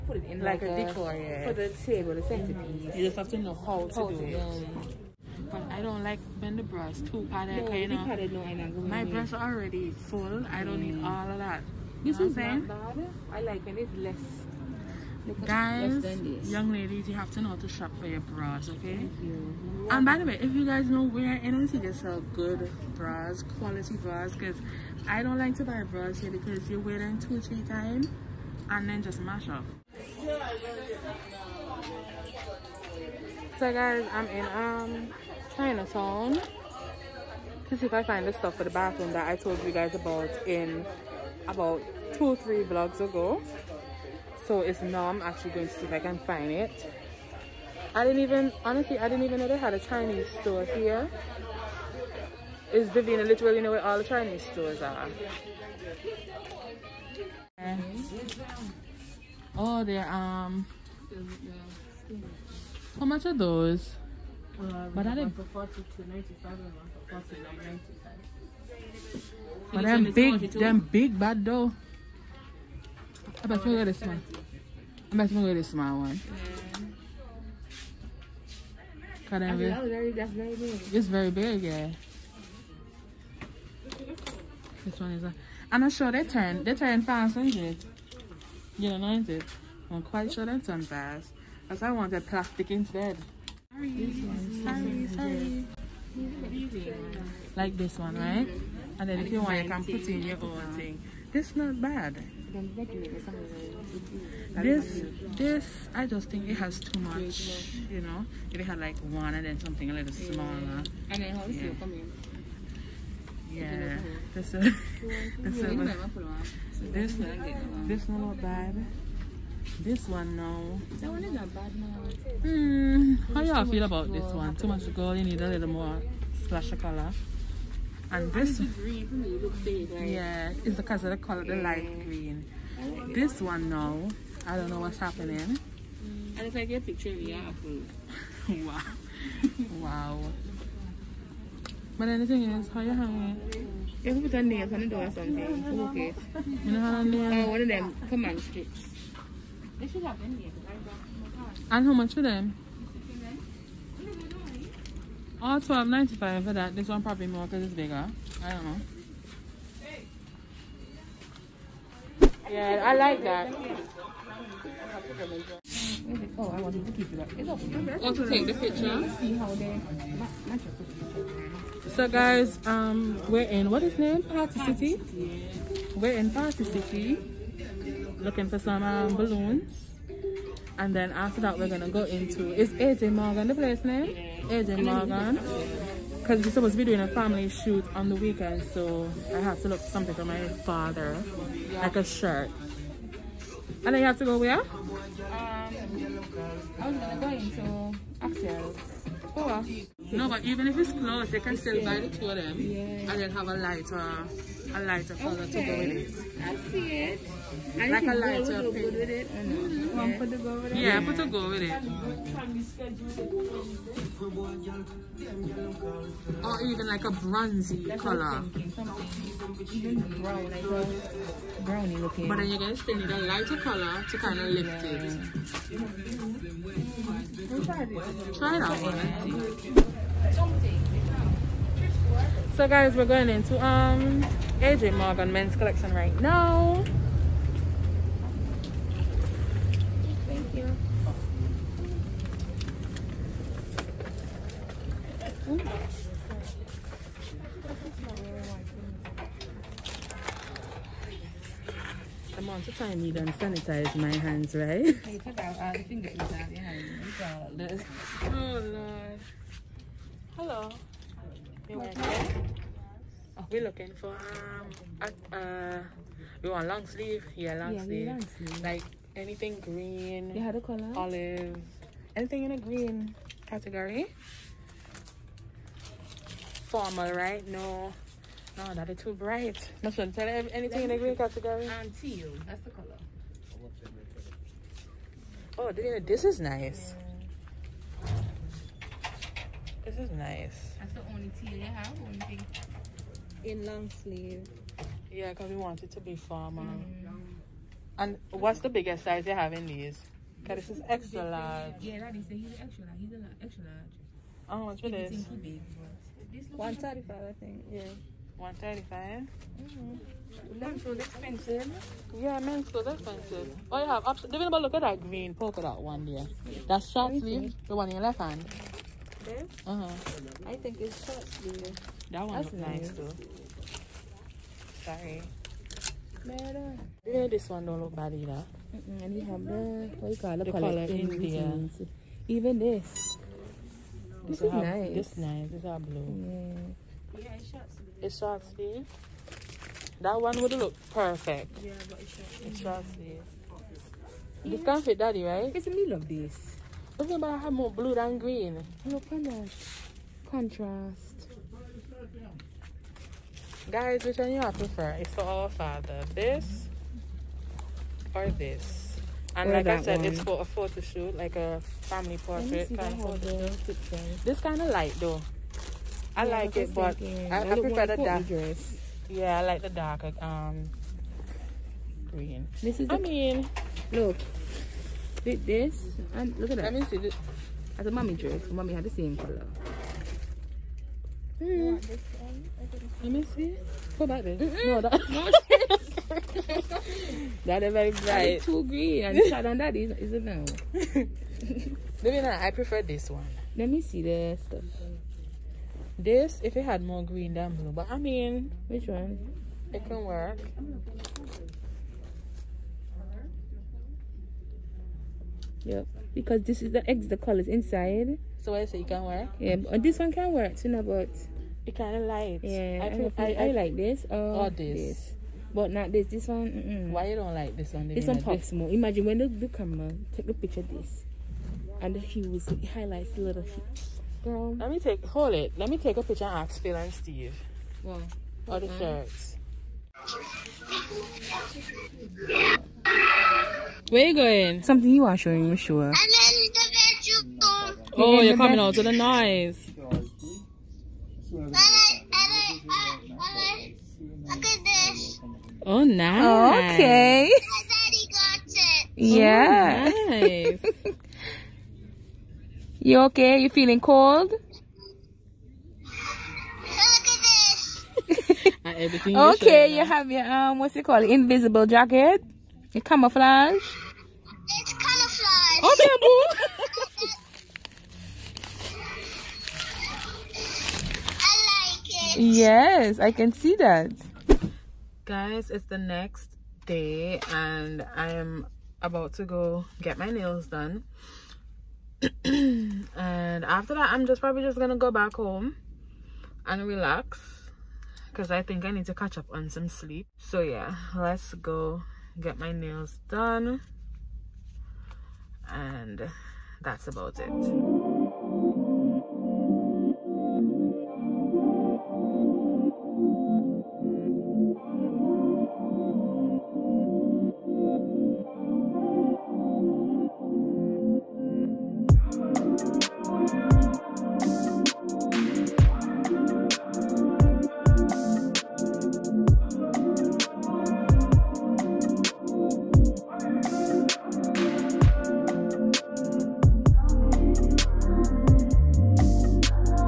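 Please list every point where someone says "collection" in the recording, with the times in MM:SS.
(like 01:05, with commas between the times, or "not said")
03:55.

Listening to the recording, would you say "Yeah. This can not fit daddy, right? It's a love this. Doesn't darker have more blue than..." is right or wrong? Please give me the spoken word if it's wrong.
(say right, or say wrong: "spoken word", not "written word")
wrong: "matter", not "darker".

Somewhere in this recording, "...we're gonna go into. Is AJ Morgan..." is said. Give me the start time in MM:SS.
03:01.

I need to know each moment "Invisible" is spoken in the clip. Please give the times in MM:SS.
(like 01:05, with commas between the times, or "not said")
07:41.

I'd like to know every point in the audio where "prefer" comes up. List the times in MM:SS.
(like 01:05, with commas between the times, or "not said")
05:54, 06:07, 06:32.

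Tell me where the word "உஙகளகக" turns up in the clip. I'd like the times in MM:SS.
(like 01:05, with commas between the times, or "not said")
not said.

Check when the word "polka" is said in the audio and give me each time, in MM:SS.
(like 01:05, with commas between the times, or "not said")
05:15.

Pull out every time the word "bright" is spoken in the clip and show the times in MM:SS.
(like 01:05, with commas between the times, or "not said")
04:39, 06:27.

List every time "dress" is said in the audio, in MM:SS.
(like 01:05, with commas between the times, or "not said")
06:08, 06:18.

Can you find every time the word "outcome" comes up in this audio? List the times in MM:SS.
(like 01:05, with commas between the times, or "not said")
not said.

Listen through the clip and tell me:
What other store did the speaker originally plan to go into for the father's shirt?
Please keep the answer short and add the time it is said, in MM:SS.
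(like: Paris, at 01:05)
Axel, at 03:18.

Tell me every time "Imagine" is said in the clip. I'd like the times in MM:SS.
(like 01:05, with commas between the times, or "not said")
06:58.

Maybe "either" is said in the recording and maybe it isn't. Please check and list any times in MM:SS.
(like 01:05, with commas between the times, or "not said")
05:28.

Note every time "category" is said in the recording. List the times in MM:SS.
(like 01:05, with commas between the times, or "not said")
04:33, 04:41.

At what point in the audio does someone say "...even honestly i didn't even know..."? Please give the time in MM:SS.
00:48.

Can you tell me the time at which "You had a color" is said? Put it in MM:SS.
04:30.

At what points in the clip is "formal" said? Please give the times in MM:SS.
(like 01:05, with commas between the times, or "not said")
04:36, 04:56.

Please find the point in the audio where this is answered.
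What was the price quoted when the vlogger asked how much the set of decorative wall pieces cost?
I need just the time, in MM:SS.
02:35.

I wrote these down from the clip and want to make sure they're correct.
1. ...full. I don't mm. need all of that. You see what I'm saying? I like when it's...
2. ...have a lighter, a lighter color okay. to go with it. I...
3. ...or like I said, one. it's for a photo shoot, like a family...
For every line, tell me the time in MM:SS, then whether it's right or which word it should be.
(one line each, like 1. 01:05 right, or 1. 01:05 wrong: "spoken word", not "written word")
1. 00:09 right
2. 03:23 right
3. 05:59 right.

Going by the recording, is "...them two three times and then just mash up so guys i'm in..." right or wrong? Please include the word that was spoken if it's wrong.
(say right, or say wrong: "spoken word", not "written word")
right.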